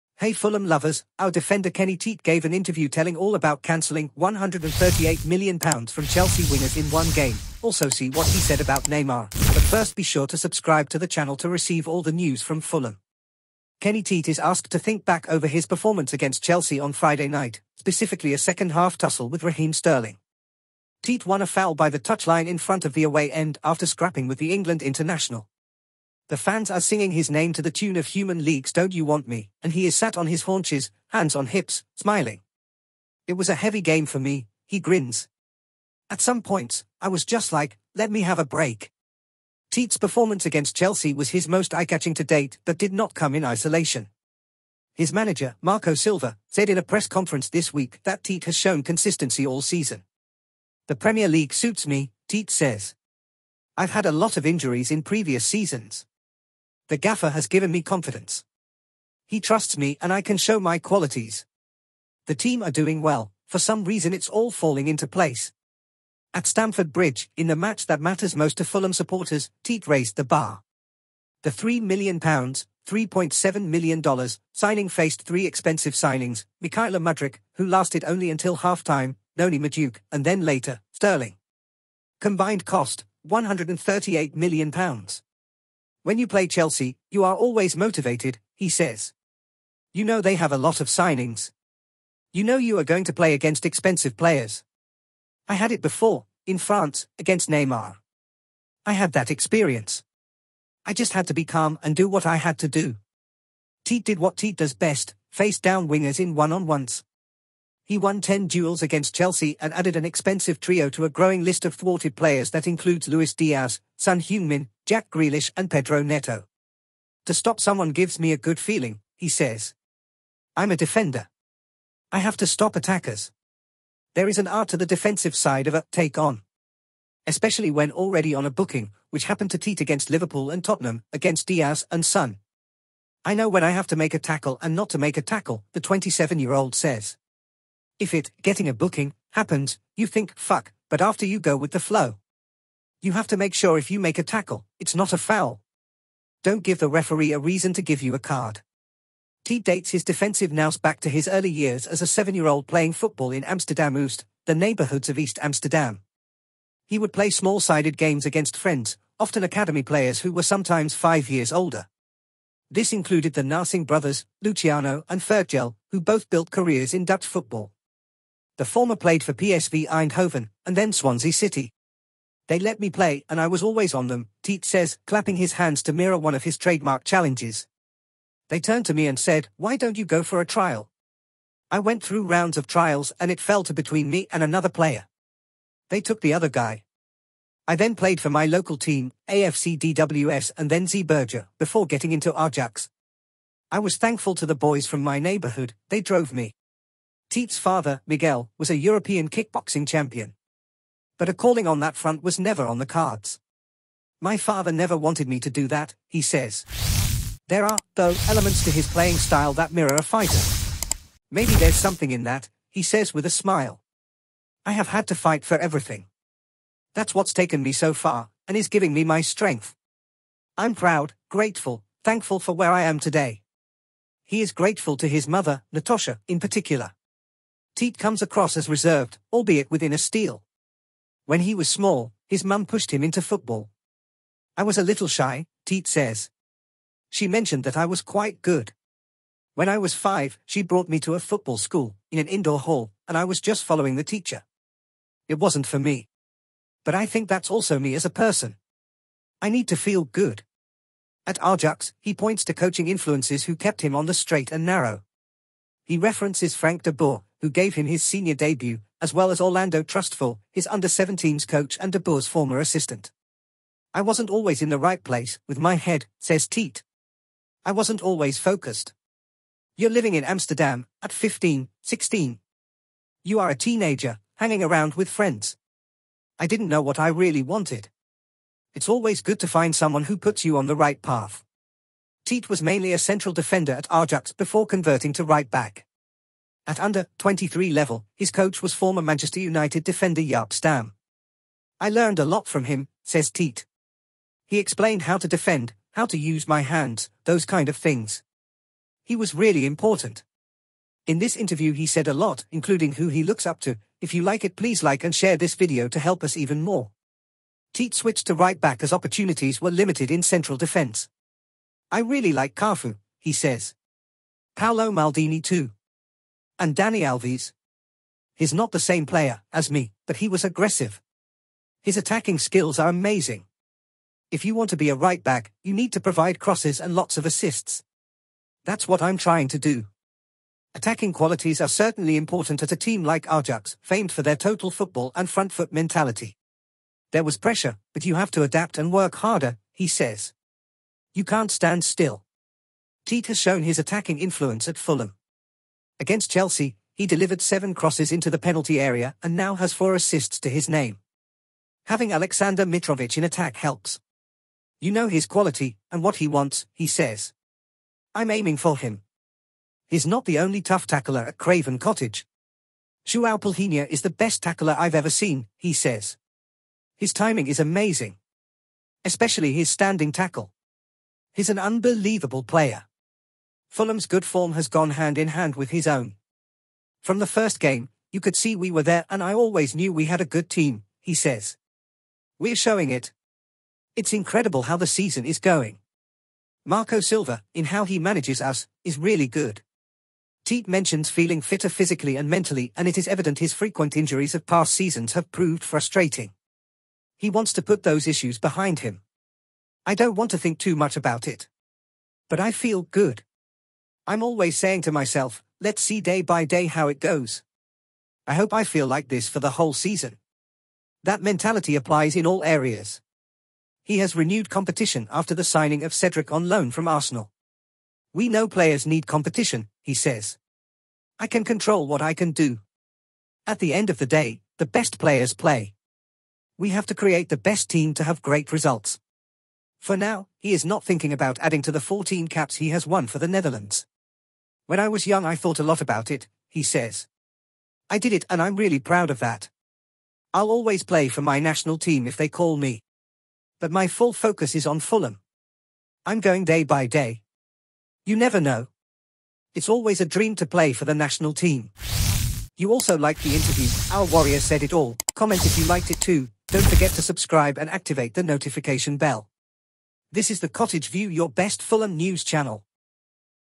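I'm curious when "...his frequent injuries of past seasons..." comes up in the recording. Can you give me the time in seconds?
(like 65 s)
393 s.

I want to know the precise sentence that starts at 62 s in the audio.
The team are doing well, for some reason it's all falling into place.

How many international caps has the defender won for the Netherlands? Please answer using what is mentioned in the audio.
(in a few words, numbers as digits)
14.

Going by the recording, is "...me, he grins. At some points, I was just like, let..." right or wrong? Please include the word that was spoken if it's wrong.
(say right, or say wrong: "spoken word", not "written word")
right.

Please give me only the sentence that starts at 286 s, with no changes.
At under-23 level, his coach was former Manchester United defender Jaap Stam.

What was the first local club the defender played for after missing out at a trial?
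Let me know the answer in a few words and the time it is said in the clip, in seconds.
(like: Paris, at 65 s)
AFC DWS, at 189 s.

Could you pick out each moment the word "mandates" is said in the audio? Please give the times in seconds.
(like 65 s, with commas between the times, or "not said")
not said.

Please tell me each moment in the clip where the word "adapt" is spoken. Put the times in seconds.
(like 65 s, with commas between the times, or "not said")
338 s.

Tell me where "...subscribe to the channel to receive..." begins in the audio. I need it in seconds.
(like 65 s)
10 s.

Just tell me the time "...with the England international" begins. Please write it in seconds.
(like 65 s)
24 s.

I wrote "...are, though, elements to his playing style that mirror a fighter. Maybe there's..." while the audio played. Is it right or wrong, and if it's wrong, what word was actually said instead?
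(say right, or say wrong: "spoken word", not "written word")
right.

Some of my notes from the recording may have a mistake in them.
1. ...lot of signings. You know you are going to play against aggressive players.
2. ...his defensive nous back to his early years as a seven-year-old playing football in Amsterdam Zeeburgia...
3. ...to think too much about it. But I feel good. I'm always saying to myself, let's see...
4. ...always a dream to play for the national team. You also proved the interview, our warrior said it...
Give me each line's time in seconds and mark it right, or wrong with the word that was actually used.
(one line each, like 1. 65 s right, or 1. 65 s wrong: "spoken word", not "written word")
1. 90 s wrong: "expensive", not "aggressive"
2. 149 s wrong: "Oost", not "Zeeburgia"
3. 400 s right
4. 449 s wrong: "liked", not "proved".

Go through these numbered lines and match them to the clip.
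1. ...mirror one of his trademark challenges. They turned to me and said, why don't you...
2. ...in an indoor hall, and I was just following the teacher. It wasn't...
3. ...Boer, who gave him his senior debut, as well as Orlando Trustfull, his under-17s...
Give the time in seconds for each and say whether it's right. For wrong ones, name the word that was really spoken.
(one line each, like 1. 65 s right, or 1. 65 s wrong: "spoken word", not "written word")
1. 175 s right
2. 242 s right
3. 256 s right.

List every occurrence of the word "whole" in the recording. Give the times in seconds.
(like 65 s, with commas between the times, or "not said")
409 s.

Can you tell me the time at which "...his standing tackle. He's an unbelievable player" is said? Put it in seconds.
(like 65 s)
369 s.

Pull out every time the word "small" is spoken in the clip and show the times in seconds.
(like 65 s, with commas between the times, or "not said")
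157 s, 231 s.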